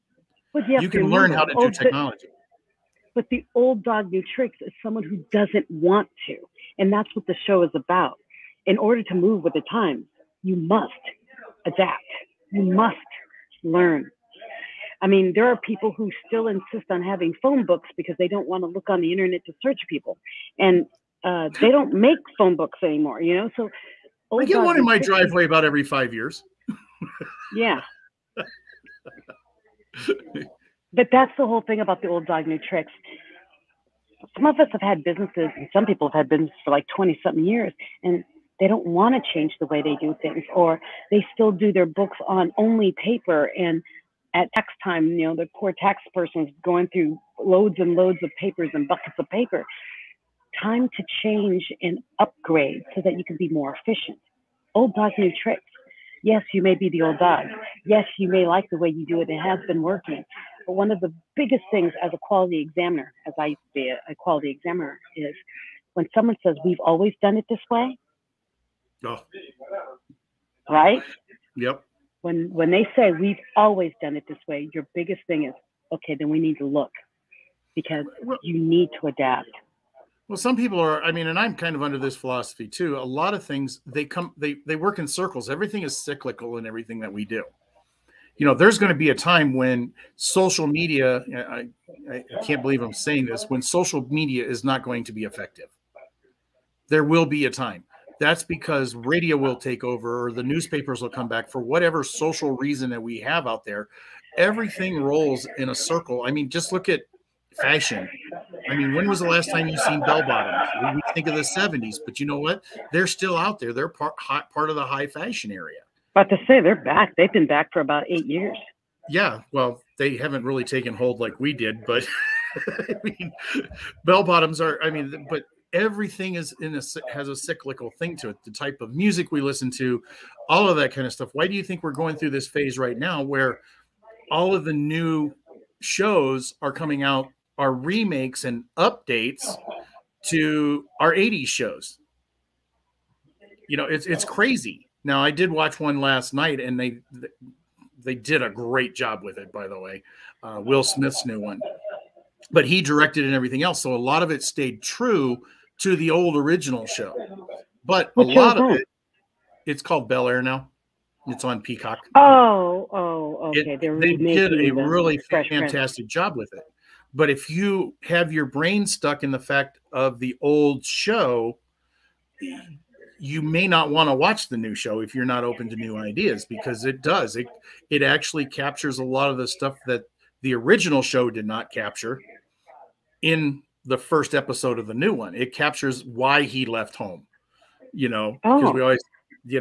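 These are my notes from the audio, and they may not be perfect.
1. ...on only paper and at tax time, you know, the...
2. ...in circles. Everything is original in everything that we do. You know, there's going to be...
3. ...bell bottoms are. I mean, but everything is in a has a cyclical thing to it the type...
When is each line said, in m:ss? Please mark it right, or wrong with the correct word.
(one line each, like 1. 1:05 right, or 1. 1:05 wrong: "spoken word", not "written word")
1. 0:42 right
2. 1:24 wrong: "cyclical", not "original"
3. 2:04 right.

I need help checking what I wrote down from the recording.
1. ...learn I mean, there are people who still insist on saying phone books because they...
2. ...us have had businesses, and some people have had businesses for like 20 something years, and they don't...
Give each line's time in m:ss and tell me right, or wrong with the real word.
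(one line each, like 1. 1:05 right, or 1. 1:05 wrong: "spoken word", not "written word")
1. 0:13 wrong: "having", not "saying"
2. 0:34 right.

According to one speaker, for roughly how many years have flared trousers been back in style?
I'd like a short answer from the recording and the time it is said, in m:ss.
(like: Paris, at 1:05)
8 years, at 1:58.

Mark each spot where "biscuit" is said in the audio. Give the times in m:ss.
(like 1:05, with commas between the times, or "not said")
not said.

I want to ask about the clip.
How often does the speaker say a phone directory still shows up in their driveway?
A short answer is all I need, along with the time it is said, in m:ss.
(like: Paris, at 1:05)
every 5 years, at 0:25.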